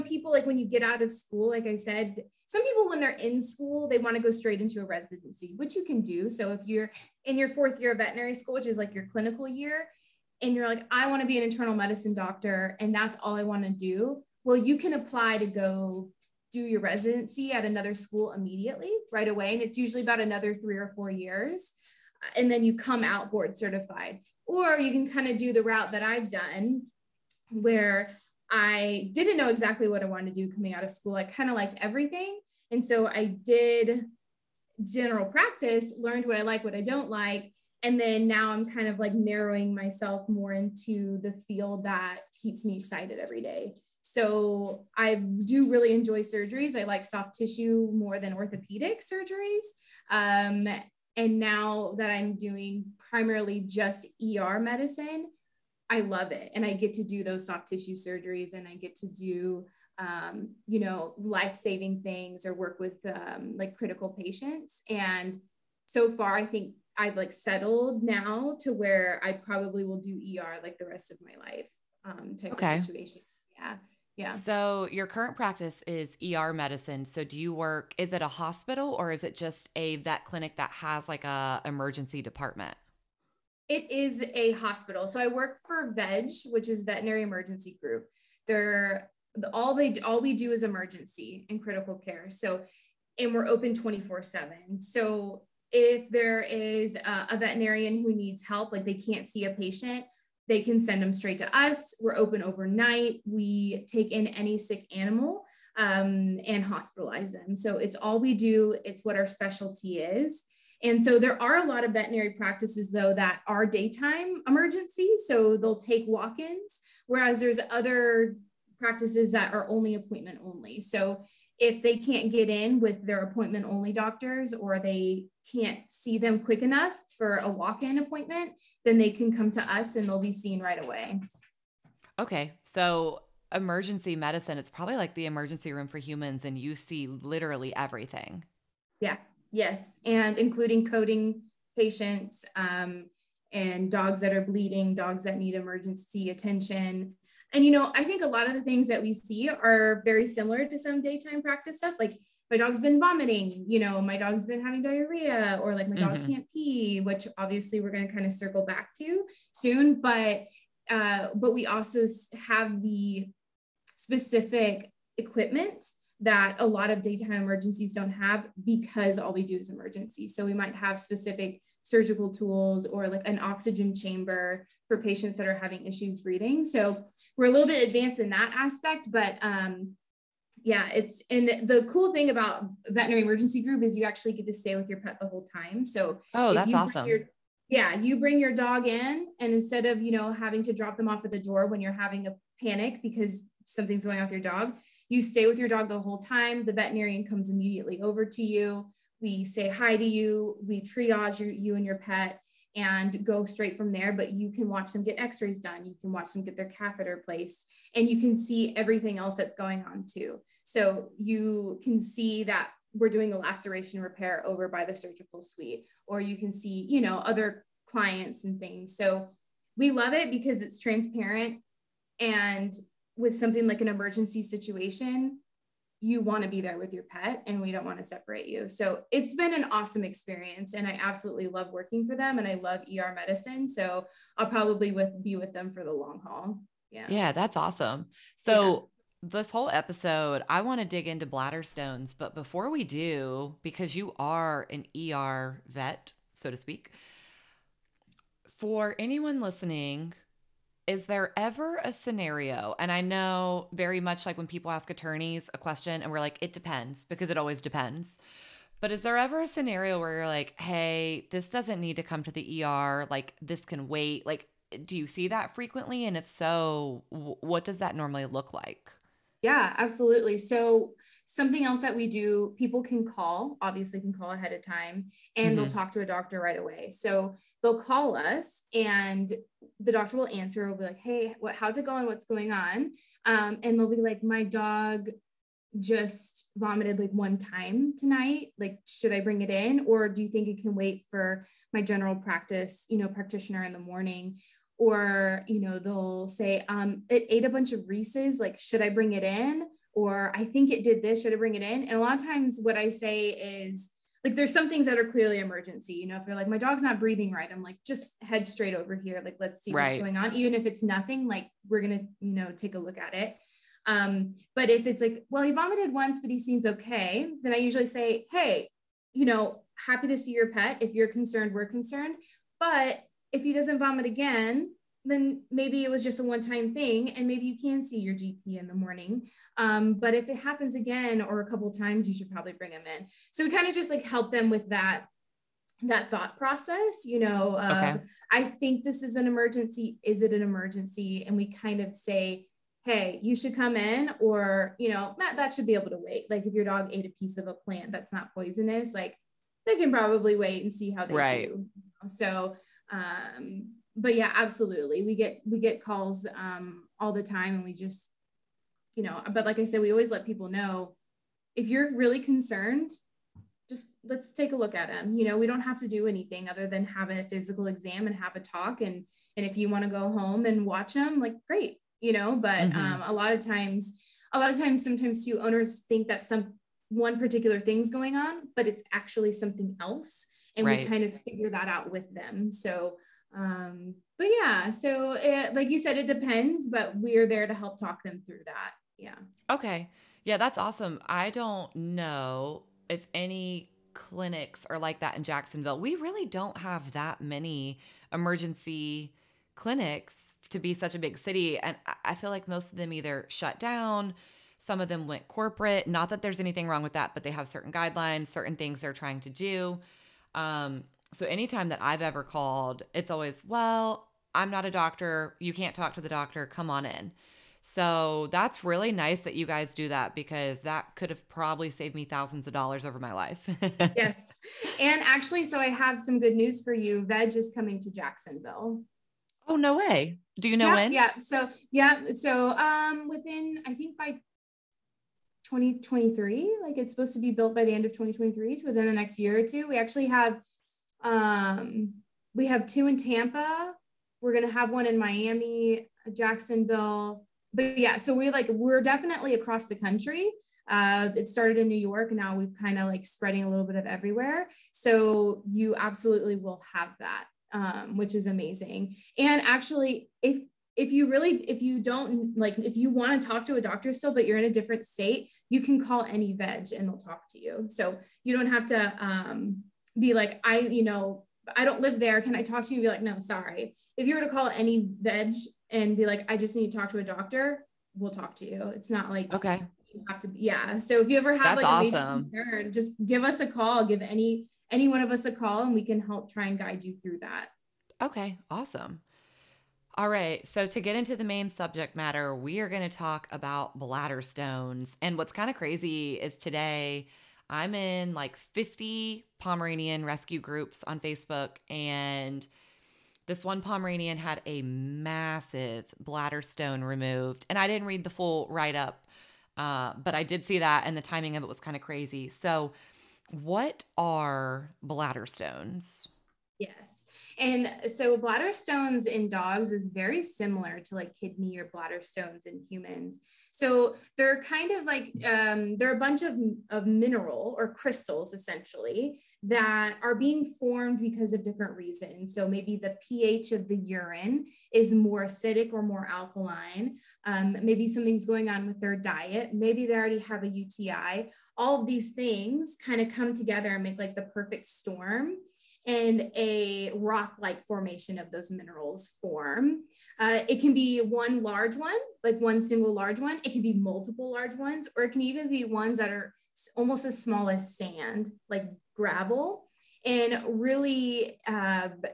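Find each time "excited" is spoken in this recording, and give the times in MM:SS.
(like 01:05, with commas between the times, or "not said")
00:42.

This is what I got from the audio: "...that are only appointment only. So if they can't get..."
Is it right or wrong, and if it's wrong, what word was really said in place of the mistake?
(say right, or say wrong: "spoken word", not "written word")
right.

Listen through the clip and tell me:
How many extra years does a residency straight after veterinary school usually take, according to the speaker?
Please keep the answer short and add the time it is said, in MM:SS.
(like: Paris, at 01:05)
3 or 4 years, at 00:20.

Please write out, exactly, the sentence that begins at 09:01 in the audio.
All of these things kind of come together and make like the perfect storm and a rock-like formation of those minerals form.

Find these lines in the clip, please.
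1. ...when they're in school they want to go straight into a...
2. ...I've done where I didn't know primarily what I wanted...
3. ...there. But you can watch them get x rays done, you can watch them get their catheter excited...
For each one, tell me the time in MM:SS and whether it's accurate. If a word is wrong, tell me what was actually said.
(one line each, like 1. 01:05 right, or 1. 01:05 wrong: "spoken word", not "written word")
1. 00:02 right
2. 00:26 wrong: "exactly", not "primarily"
3. 03:23 wrong: "placed", not "excited".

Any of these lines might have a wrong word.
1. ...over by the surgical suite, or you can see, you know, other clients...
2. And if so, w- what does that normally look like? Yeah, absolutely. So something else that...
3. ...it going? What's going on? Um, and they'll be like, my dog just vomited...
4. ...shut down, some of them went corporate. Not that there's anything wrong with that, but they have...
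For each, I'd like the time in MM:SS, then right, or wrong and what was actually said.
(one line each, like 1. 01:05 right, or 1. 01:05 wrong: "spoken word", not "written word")
1. 03:34 right
2. 04:26 right
3. 04:41 right
4. 06:43 right.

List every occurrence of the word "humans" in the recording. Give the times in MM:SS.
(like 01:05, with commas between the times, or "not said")
02:15, 08:42.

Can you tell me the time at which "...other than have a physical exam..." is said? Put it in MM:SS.
06:06.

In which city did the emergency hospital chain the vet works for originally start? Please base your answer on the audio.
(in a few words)
New York.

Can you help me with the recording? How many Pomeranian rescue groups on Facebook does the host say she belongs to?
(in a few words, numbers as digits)
50.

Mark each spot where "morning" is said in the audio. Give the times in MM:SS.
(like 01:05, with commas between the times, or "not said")
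04:53, 05:28.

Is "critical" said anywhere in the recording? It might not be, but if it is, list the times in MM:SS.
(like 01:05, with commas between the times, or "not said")
01:03, 01:31.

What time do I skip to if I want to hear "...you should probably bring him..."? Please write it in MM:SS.
05:32.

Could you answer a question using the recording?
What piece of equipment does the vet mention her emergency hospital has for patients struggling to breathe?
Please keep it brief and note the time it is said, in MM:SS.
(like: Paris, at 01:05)
Oxygen chamber, at 02:53.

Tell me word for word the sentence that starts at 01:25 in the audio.
So I work for VEG, which is Veterinary Emergency Group.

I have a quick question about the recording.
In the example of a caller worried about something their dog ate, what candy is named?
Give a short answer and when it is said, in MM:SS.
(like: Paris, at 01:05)
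Reese's, at 04:57.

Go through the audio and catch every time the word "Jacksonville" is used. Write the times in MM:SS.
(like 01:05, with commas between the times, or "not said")
06:35, 07:07, 07:26.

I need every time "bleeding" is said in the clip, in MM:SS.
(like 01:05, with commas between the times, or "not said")
02:24.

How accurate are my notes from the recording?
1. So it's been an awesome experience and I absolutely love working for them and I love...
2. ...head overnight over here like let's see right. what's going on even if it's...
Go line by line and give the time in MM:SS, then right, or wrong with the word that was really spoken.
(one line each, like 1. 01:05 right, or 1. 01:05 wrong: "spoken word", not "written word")
1. 03:48 right
2. 05:08 wrong: "straight", not "overnight".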